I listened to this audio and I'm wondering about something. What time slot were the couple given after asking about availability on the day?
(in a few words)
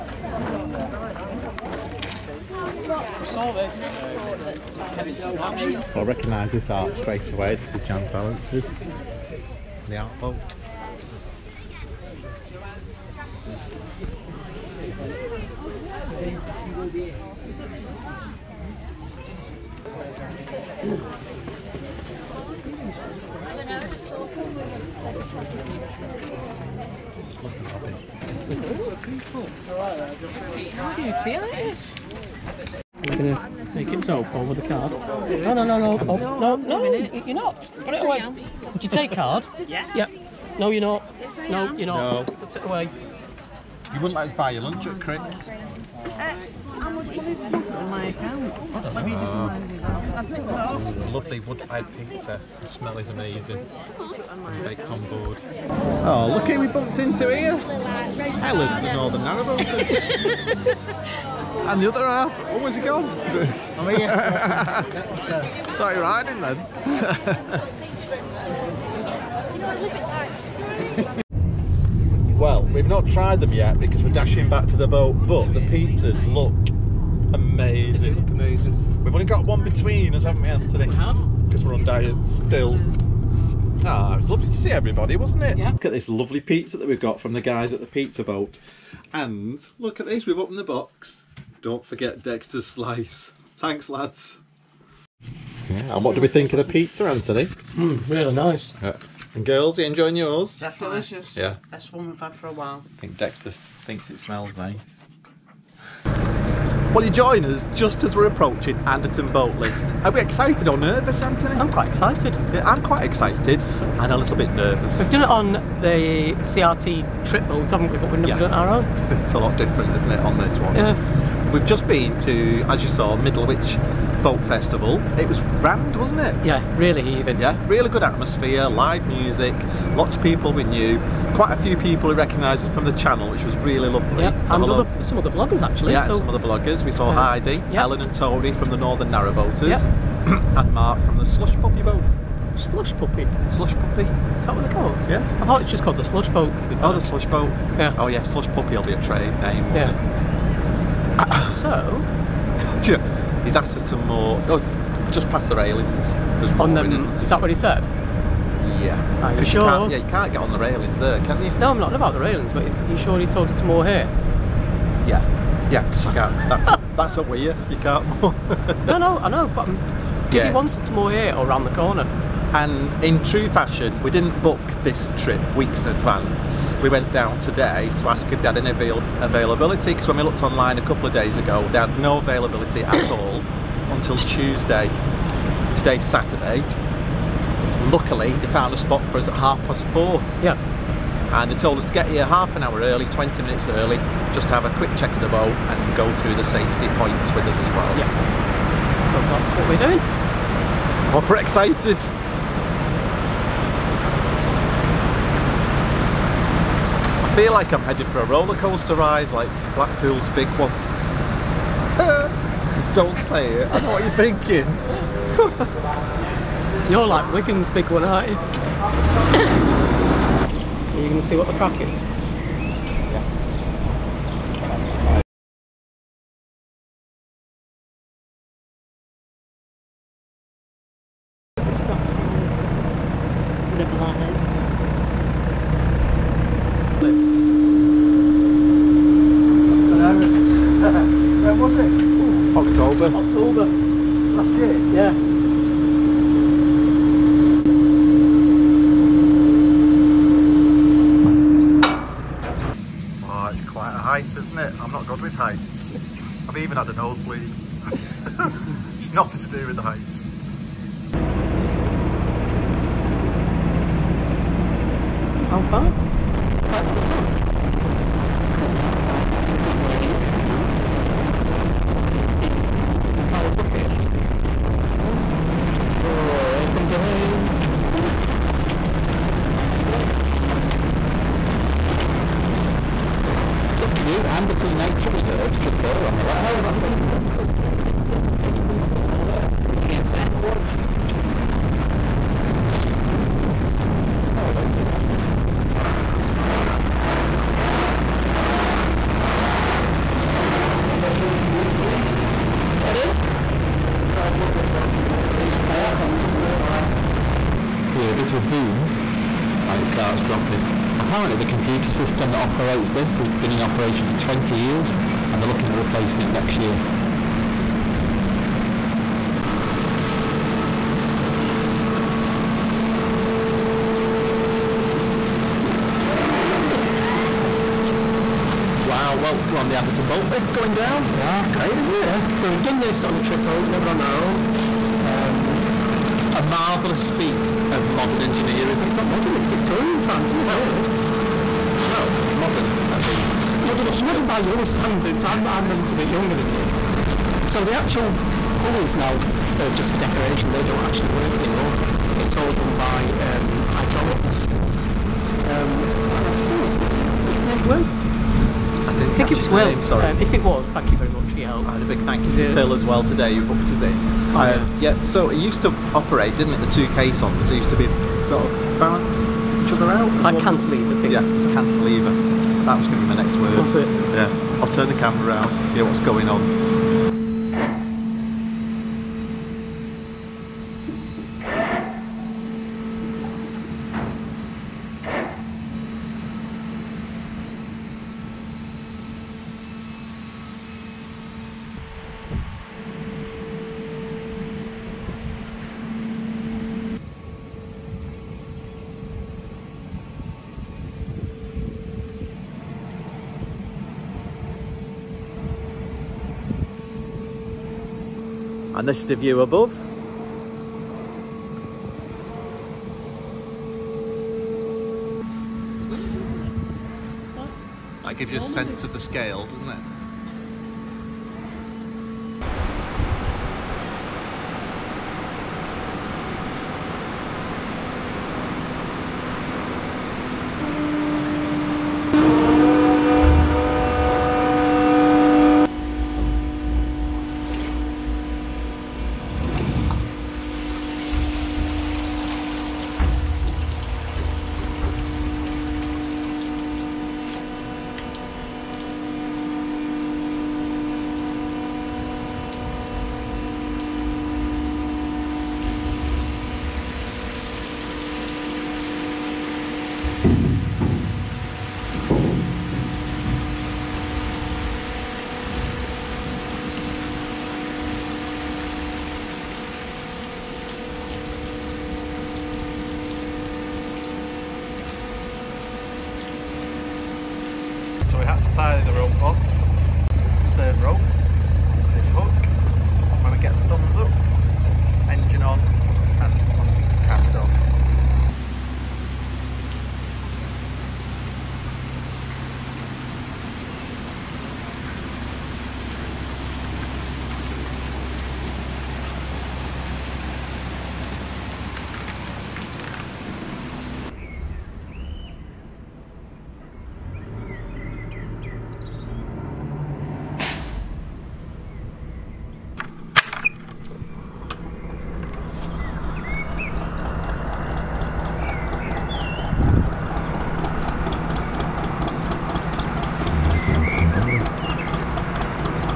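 half past four.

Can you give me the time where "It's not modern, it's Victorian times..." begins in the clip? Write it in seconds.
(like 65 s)
338 s.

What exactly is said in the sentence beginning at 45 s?
Uh, how much money on my account?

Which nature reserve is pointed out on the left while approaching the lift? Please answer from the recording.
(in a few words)
Anderton Nature Reserve.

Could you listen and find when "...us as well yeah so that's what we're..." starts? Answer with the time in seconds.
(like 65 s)
197 s.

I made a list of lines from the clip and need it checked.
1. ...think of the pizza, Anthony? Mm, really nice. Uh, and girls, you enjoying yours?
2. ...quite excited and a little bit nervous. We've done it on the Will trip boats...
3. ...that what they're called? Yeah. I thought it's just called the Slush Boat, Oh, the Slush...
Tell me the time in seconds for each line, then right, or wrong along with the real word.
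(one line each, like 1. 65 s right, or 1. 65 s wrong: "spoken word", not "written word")
1. 96 s right
2. 112 s wrong: "CRT", not "Will"
3. 144 s right.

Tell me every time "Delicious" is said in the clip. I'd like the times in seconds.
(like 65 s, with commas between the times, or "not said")
101 s.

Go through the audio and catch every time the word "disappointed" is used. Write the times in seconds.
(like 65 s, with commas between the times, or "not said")
not said.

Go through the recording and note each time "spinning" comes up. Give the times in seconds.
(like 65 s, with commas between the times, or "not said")
not said.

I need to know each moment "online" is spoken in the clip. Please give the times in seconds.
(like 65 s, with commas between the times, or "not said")
180 s.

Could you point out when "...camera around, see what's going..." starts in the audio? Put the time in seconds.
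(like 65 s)
374 s.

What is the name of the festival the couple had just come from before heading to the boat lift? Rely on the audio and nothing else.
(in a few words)
Middlewich Boat Festival.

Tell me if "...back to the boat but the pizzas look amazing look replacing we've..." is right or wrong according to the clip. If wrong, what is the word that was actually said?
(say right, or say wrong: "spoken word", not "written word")
wrong: "amazing", not "replacing".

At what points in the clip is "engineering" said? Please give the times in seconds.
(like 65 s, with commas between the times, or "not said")
338 s.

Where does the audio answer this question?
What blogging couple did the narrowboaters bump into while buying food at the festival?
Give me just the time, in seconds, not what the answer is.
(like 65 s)
58 s.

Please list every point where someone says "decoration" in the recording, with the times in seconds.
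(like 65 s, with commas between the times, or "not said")
349 s.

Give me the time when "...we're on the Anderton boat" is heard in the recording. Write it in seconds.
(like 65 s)
329 s.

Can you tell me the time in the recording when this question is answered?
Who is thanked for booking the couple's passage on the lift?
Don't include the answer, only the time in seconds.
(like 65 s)
362 s.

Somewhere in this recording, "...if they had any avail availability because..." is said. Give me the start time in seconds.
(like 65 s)
178 s.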